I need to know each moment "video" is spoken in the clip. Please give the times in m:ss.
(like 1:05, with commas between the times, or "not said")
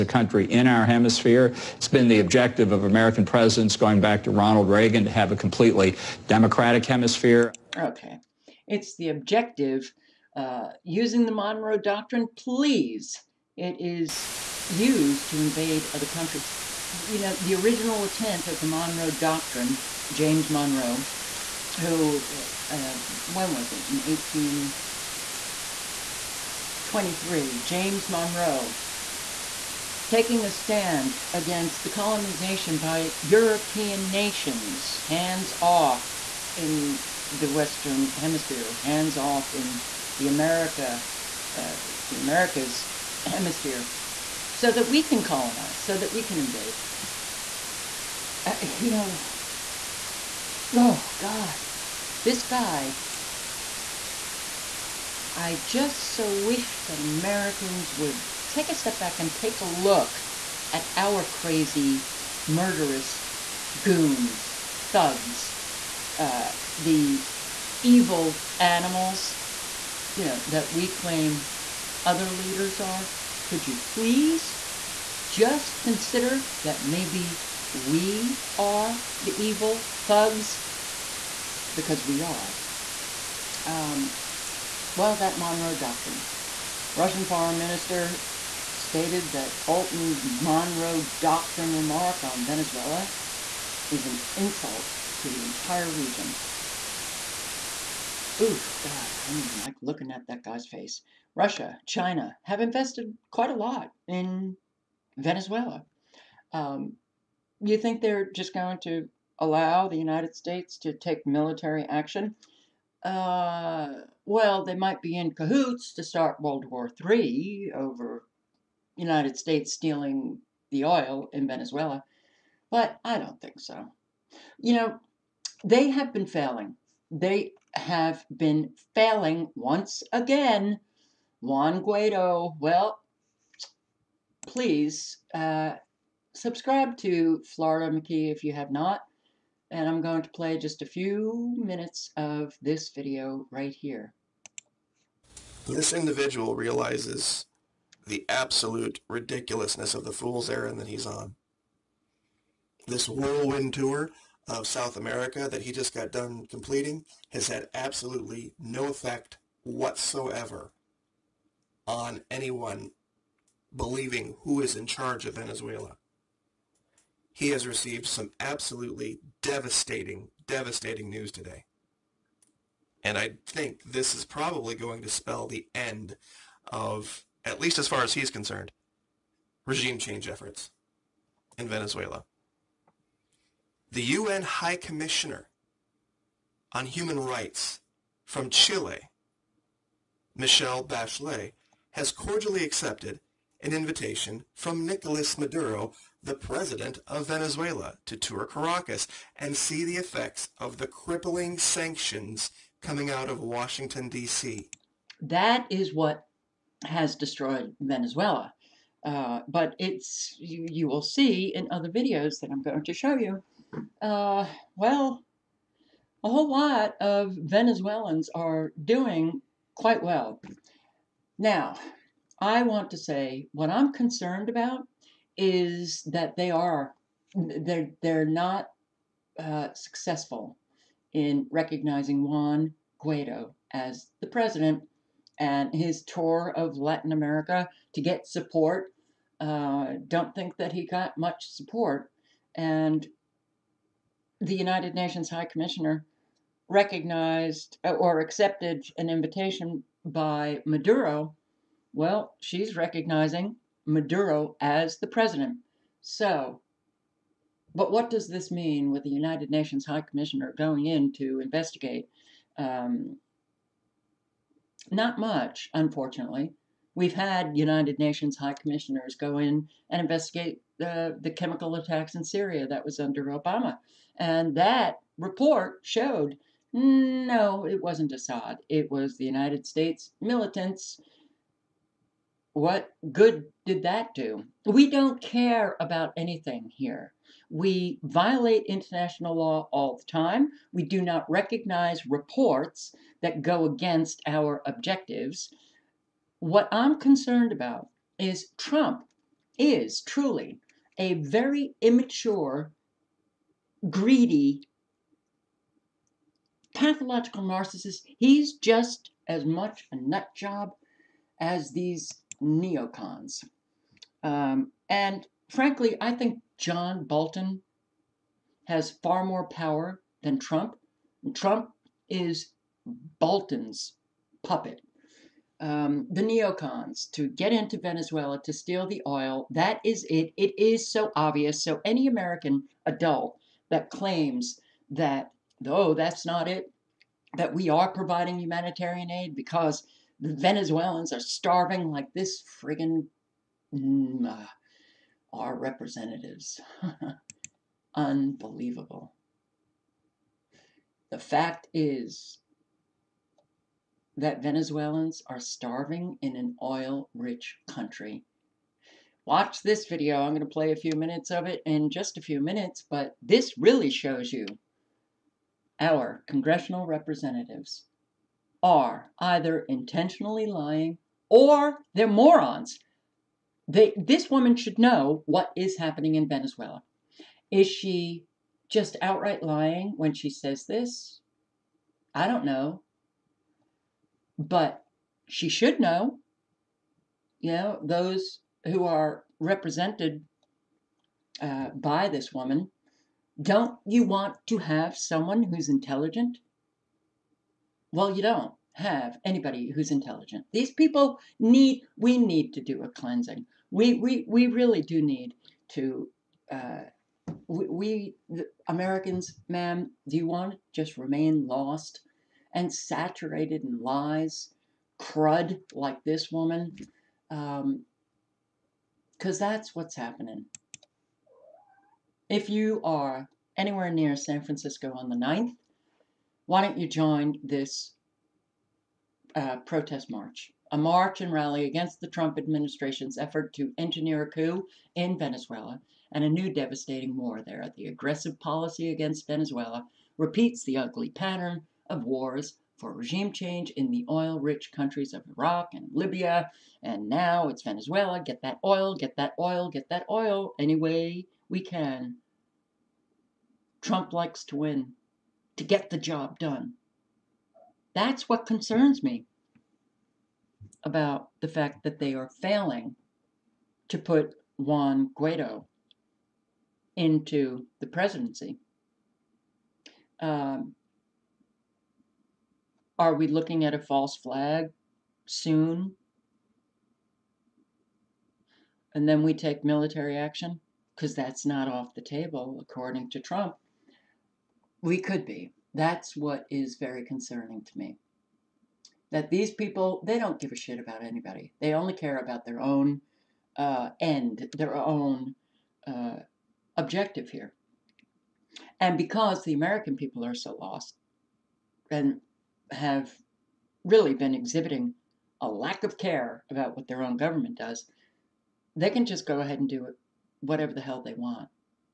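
2:22, 3:31, 5:59.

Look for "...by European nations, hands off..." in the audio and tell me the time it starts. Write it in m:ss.
0:32.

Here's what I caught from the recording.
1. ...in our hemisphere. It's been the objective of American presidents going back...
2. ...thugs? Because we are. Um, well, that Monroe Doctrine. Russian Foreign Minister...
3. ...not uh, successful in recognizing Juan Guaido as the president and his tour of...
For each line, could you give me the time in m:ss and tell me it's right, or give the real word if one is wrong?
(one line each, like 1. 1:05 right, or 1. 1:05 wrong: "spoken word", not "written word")
1. 0:00 right
2. 1:20 right
3. 3:48 right.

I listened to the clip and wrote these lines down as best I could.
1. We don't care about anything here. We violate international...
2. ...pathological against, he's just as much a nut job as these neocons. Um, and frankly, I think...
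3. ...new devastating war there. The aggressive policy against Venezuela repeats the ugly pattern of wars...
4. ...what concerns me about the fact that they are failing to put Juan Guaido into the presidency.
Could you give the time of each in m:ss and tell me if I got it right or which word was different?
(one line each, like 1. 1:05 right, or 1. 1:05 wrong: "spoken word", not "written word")
1. 4:44 right
2. 5:06 wrong: "narcissist", not "against"
3. 7:16 right
4. 7:38 right.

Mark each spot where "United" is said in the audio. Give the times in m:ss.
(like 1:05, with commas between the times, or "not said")
1:49, 1:58, 4:04, 4:19, 4:27, 4:39.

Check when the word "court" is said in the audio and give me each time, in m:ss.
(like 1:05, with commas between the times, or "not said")
not said.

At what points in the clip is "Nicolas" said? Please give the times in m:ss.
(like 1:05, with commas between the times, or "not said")
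3:14.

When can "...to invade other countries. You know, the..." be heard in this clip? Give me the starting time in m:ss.
0:15.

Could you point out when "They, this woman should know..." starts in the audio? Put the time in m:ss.
6:13.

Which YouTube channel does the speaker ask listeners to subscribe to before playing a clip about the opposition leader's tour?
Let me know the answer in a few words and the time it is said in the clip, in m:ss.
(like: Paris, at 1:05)
Florida McKee, at 2:17.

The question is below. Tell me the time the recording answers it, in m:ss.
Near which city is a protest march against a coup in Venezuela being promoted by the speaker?
7:04.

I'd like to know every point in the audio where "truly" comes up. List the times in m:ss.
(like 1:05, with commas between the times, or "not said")
5:00.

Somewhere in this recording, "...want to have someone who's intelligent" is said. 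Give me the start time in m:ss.
6:34.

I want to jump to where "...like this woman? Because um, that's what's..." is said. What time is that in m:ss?
6:55.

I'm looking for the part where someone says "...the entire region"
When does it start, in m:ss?
1:35.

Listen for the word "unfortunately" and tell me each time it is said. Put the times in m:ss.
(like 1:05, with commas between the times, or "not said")
4:25.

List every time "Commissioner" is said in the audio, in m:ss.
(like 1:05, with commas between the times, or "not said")
3:04, 4:05, 4:20, 4:28.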